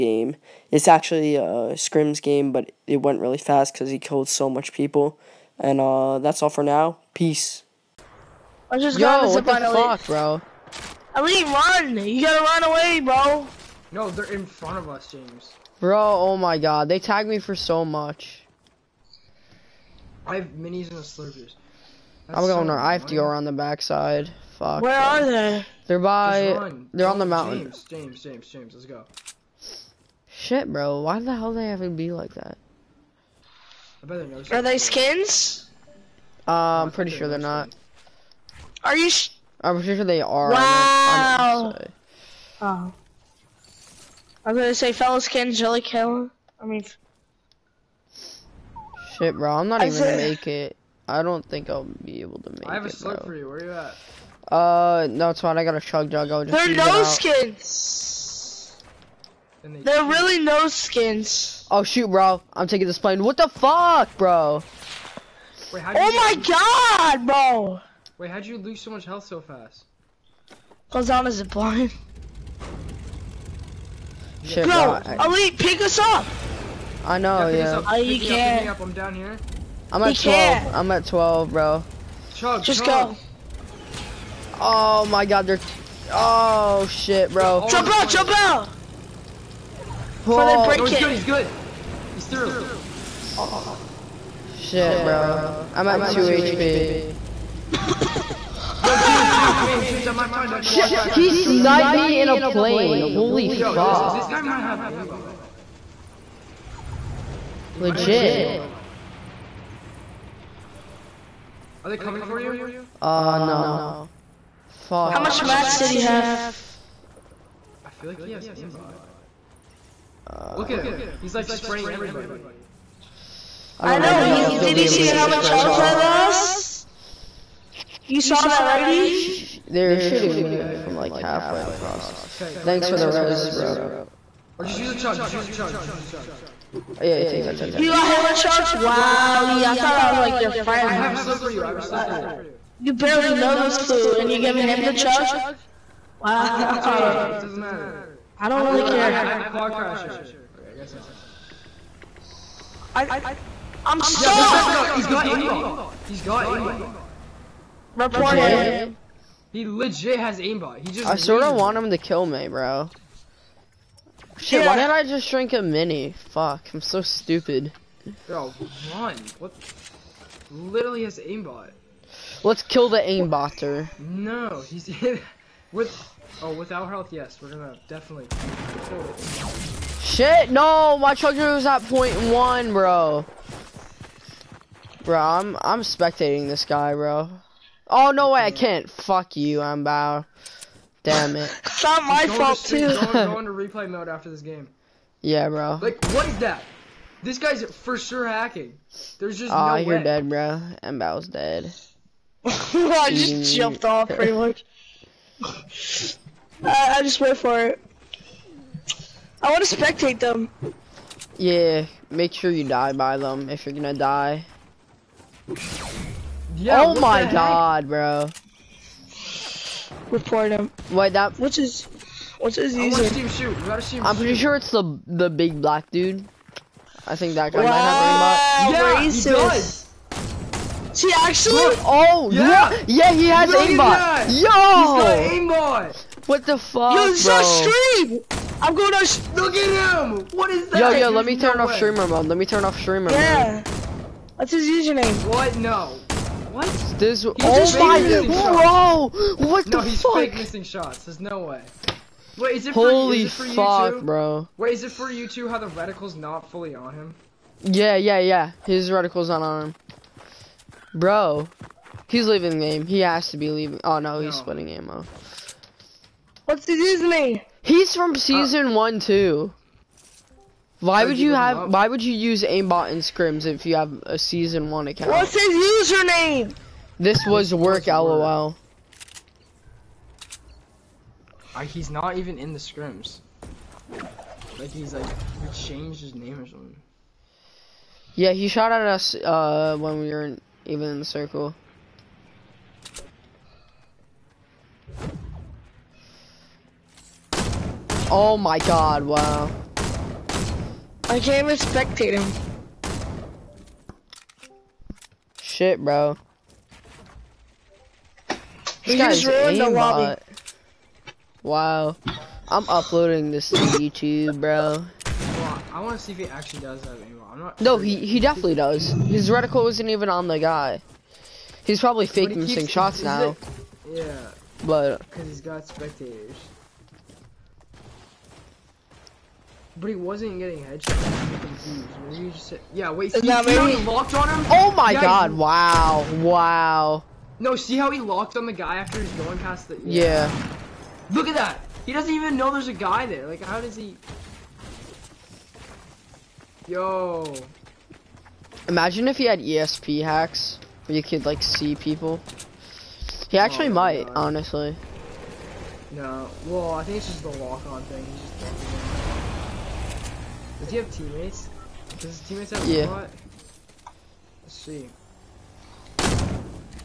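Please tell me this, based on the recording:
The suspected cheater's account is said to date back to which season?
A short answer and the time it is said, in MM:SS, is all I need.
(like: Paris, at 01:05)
Season one, at 04:28.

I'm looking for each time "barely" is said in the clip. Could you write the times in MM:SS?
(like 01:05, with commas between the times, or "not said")
02:22.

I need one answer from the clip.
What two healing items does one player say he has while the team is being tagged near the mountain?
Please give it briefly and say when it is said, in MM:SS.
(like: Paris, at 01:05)
Minis and slurpers, at 00:20.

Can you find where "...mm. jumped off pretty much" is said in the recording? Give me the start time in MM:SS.
03:23.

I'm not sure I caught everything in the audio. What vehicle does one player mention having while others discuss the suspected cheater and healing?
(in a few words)
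Quad crasher.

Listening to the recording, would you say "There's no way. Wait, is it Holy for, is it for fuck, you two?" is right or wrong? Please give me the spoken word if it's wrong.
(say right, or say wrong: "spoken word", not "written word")
right.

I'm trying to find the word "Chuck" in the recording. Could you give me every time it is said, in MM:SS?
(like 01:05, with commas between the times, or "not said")
02:18, 02:24.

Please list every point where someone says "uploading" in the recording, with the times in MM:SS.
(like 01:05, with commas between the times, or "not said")
05:12.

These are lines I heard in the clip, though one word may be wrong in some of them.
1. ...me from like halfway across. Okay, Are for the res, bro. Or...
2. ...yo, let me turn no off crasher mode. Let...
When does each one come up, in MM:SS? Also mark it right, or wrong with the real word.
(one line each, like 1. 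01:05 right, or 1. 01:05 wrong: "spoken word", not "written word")
1. 02:10 wrong: "Thanks", not "Are"
2. 04:00 wrong: "streamer", not "crasher".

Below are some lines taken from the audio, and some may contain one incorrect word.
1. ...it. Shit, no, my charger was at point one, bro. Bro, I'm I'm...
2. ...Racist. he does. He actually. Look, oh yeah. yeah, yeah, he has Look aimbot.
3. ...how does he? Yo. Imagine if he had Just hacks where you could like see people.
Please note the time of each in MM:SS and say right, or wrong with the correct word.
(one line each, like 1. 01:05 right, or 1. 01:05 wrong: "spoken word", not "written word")
1. 02:59 right
2. 03:49 right
3. 05:43 wrong: "ESP", not "Just".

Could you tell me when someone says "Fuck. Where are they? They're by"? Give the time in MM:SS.
00:24.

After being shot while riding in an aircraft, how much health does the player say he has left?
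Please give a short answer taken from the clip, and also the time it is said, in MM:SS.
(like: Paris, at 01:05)
2 HP, at 01:36.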